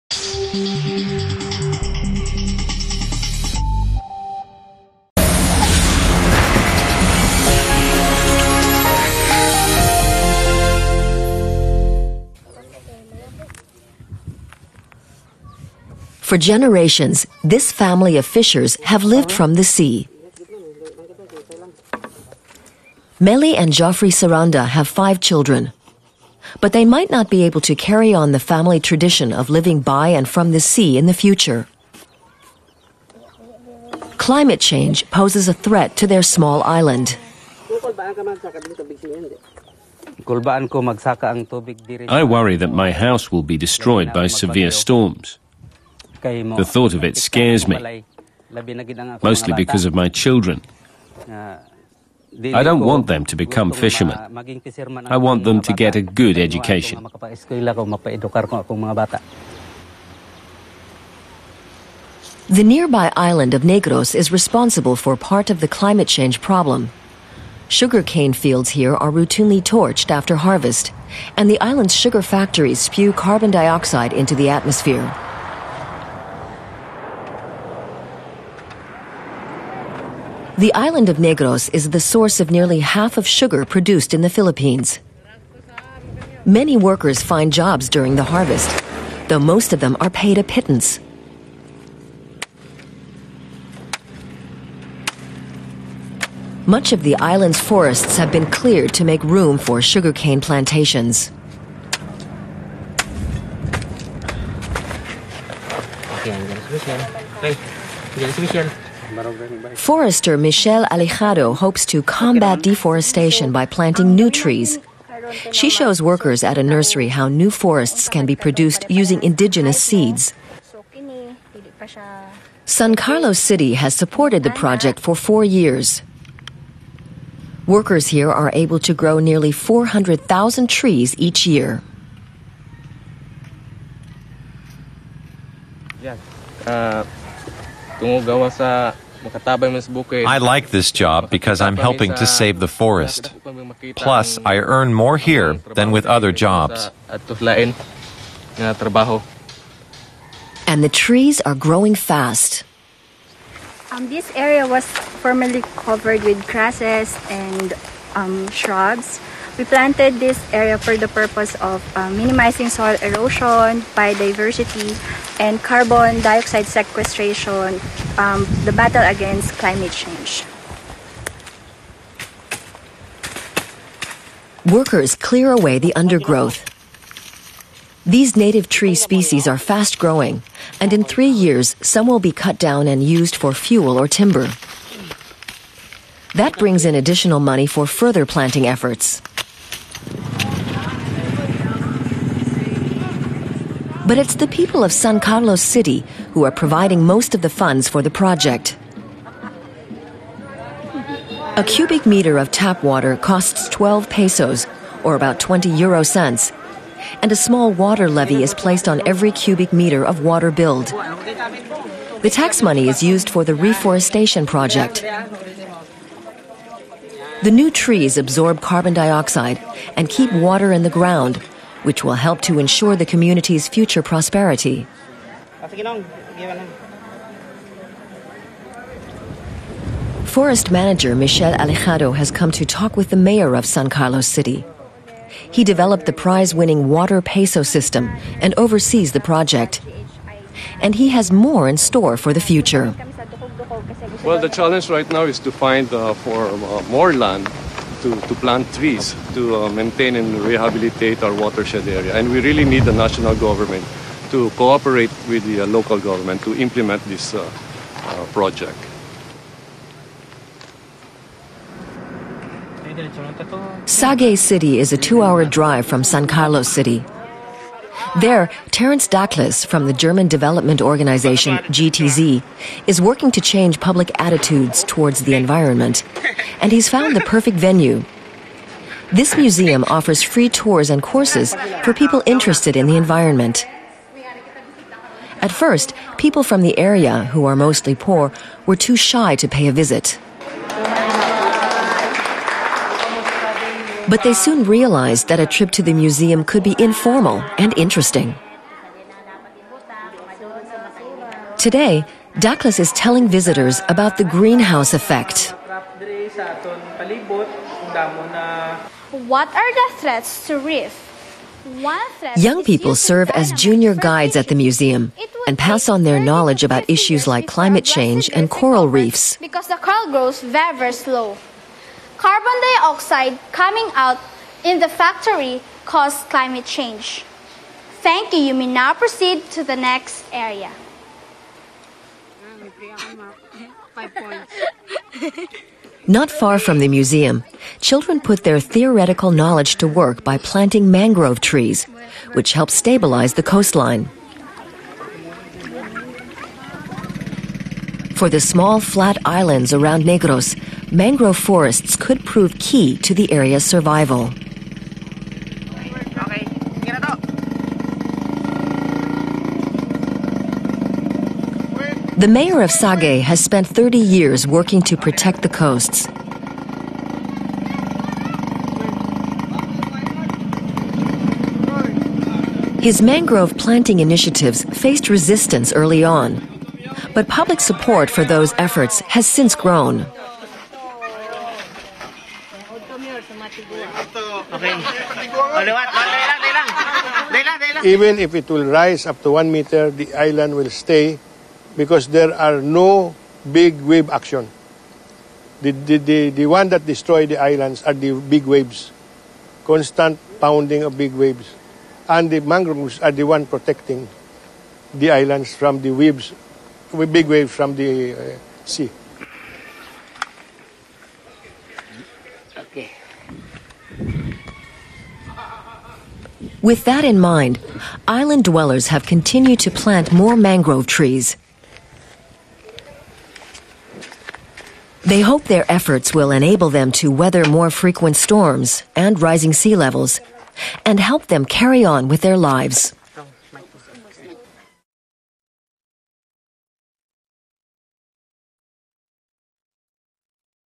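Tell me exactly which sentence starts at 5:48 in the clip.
For the small flat islands around Negros, mangrove forests could prove key to the area's survival.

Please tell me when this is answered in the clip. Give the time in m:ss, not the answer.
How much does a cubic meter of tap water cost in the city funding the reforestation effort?
3:23.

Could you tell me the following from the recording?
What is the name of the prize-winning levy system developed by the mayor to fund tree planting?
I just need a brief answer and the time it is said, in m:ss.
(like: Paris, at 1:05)
water peso system, at 3:56.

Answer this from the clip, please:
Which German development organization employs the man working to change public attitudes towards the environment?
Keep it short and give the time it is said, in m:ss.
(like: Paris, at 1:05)
GTZ, at 4:31.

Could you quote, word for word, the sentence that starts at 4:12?
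And we really need the national government to cooperate with the uh, local government to implement this uh, uh project.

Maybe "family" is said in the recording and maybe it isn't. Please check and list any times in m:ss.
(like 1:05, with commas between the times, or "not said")
0:17, 0:28.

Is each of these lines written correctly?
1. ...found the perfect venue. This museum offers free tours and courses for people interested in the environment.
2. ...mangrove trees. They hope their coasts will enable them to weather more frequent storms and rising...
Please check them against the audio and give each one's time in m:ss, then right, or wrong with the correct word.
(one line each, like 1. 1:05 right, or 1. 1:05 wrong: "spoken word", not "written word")
1. 4:36 right
2. 7:00 wrong: "efforts", not "coasts".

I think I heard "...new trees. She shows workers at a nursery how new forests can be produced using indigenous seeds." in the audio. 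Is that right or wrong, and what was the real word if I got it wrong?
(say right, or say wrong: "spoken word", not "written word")
right.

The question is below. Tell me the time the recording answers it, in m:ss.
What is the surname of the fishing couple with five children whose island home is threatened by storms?
0:24.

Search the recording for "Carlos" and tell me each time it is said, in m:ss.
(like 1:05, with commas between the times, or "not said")
2:02, 3:15, 3:53, 4:26.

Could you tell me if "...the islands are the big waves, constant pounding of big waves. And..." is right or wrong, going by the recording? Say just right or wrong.
right.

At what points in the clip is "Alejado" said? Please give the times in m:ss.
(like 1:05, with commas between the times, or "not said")
1:50, 3:51.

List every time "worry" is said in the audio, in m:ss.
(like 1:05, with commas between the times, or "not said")
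0:42.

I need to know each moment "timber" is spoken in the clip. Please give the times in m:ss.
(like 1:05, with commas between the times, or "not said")
3:04.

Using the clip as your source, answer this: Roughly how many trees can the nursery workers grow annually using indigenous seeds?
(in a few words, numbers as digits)
400,000.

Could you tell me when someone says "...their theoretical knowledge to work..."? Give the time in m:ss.
5:38.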